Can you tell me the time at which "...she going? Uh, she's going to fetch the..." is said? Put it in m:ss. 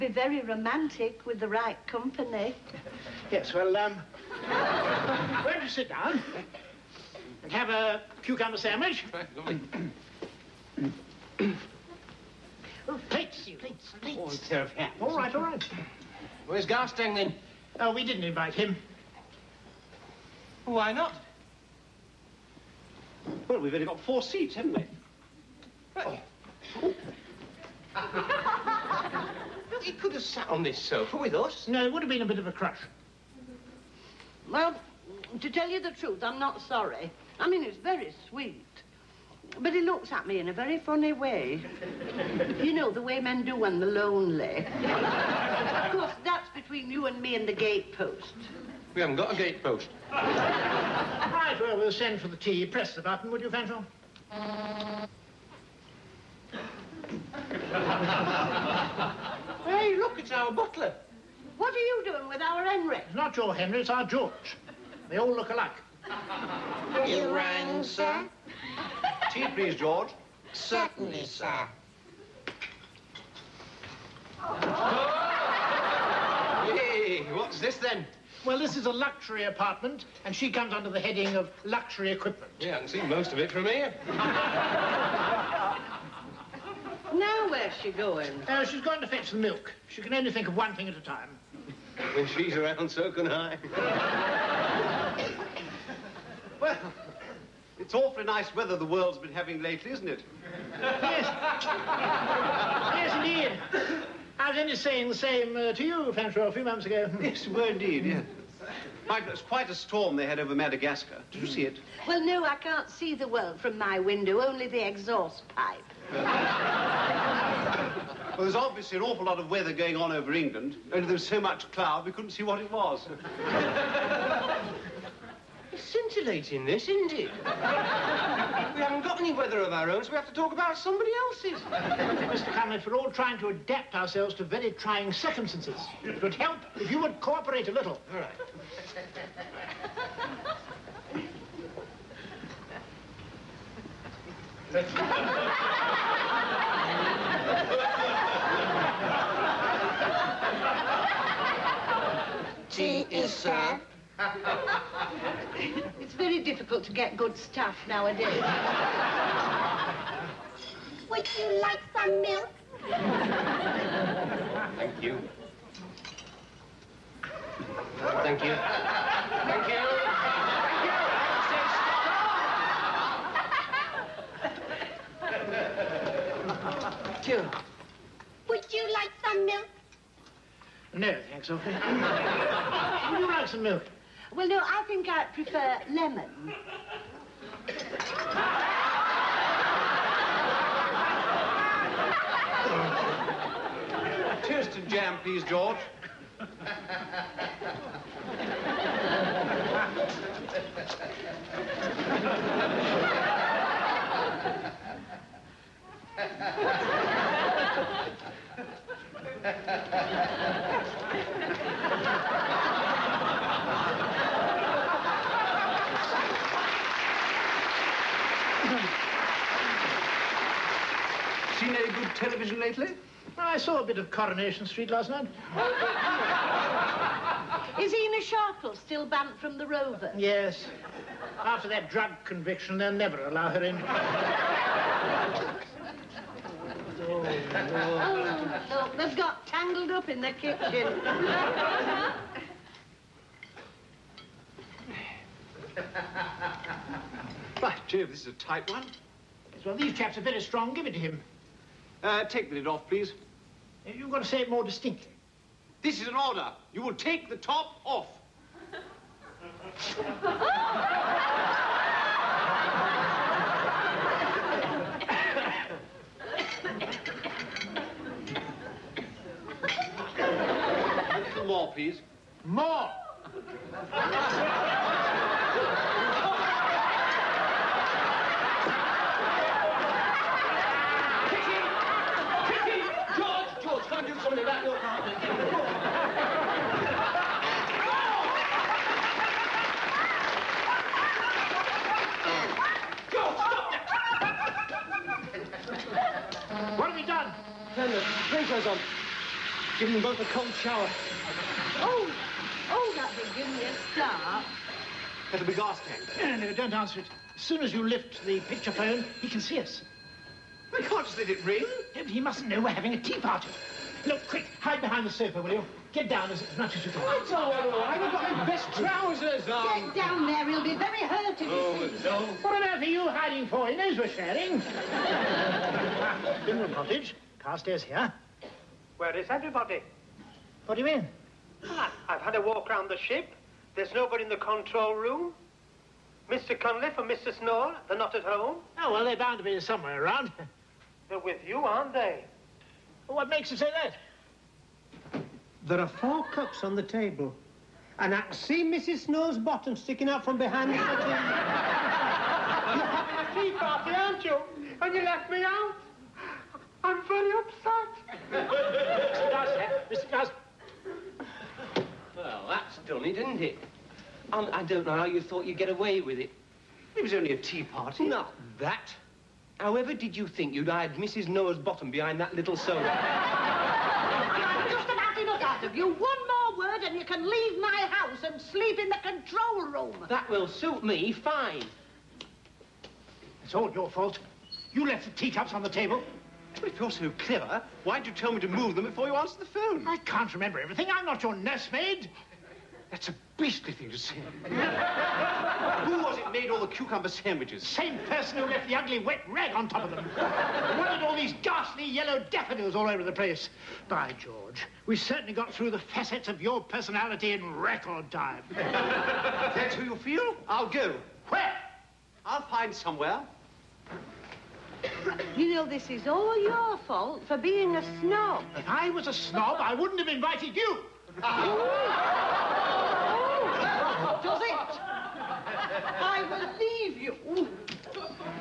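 1:27.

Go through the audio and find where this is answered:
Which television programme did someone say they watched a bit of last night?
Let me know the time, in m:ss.
3:44.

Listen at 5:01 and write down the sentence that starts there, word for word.
Oh, oh, that would give me a start.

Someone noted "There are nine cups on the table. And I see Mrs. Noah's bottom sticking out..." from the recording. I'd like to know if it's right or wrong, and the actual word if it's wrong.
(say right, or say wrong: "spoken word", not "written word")
wrong: "four", not "nine".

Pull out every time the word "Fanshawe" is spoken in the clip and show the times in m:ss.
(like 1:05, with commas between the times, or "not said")
0:53, 1:46.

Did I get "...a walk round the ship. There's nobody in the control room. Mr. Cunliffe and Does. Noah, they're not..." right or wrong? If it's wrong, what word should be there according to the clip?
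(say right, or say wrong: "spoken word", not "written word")
wrong: "Mrs", not "Does".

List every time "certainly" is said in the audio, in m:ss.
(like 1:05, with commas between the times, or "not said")
1:10, 6:44.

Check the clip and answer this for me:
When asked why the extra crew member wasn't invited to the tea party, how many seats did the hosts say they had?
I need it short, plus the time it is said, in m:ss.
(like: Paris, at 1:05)
4, at 0:24.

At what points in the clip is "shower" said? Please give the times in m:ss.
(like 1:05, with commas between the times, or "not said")
5:00.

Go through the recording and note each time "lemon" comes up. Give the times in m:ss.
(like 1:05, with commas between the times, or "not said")
3:05.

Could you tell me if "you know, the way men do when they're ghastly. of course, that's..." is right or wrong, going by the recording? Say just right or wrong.
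wrong.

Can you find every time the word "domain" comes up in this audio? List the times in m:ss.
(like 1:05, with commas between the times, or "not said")
not said.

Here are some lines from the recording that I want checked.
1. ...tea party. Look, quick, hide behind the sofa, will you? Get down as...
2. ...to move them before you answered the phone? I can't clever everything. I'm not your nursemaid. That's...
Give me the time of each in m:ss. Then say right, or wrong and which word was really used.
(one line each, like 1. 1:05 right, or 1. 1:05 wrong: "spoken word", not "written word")
1. 5:13 right
2. 6:28 wrong: "remember", not "clever".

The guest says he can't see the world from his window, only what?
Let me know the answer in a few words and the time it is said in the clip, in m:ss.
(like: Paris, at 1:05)
The exhaust pipe, at 1:54.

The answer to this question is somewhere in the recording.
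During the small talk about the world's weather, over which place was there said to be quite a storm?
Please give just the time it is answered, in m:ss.
1:50.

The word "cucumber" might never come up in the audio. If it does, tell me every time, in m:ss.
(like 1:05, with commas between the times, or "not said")
0:08, 6:36.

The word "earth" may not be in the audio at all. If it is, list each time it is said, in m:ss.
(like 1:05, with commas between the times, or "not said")
5:22.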